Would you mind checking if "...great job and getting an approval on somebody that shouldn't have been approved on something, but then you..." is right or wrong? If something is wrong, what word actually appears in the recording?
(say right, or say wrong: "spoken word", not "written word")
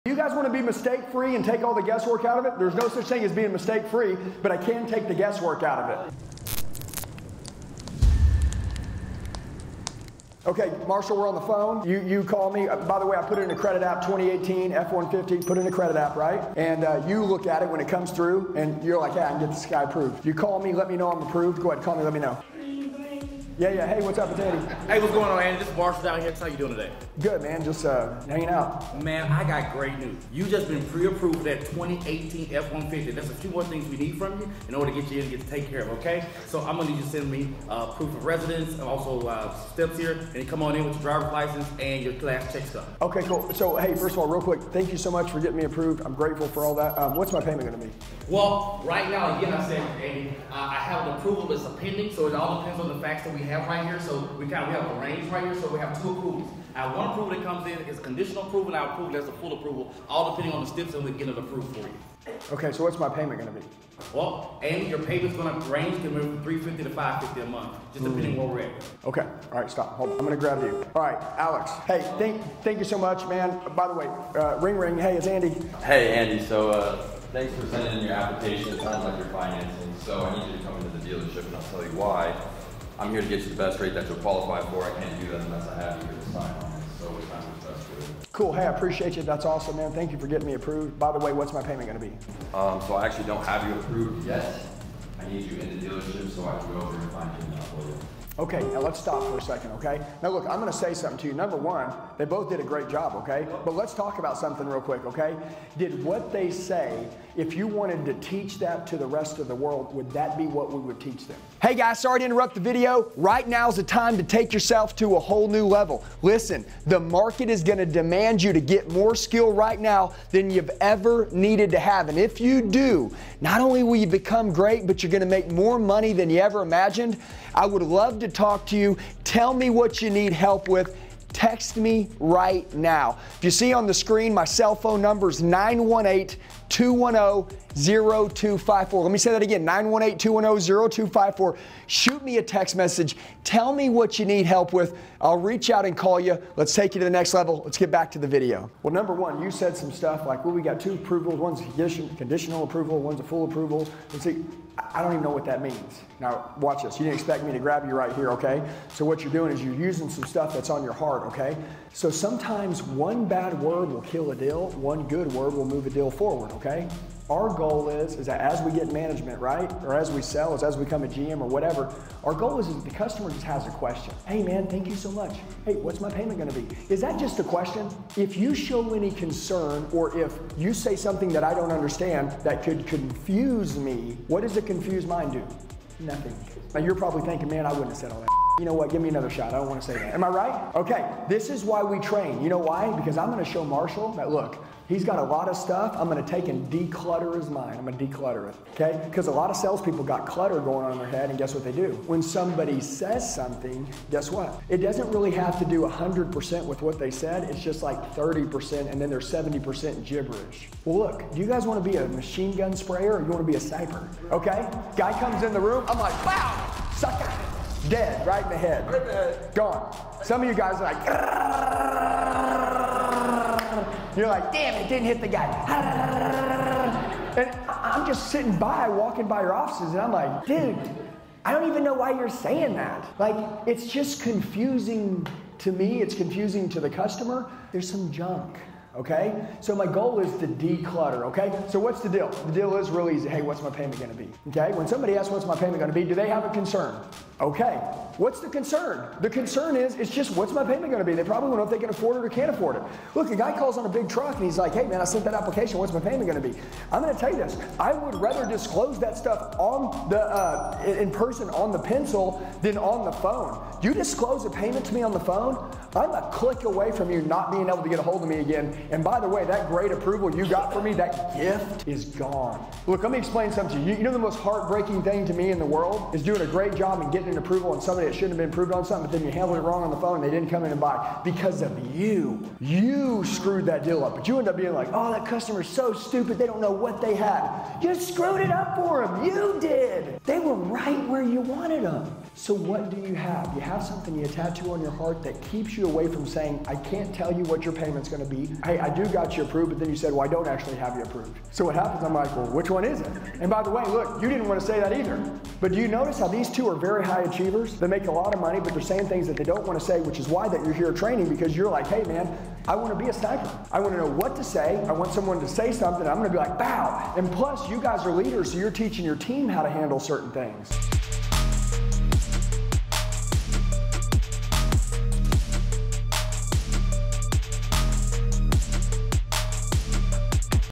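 right.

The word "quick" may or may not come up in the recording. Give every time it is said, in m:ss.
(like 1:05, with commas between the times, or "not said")
0:44, 1:44.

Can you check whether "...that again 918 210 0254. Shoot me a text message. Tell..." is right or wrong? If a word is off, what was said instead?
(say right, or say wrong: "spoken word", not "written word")
right.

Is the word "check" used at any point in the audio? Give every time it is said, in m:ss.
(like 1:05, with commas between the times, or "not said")
0:42.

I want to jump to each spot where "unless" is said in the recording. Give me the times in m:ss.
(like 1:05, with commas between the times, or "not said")
1:25.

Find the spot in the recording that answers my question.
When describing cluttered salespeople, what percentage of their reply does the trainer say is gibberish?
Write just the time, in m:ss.
3:29.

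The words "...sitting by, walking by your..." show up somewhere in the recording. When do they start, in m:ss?
3:48.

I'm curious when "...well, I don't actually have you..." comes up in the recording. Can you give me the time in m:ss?
5:00.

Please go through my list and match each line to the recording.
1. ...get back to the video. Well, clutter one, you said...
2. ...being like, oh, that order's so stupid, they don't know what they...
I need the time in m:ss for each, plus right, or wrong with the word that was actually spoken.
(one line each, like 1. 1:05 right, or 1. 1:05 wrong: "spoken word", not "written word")
1. 2:27 wrong: "number", not "clutter"
2. 4:44 wrong: "customer", not "order".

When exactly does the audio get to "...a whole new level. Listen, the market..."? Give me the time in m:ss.
1:55.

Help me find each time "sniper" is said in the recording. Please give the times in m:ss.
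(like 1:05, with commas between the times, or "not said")
3:33, 5:13.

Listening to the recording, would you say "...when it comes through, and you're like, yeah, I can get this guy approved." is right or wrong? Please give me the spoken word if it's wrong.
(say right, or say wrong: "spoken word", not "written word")
right.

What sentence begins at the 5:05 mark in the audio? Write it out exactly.
But do you notice how these two are very high achievers?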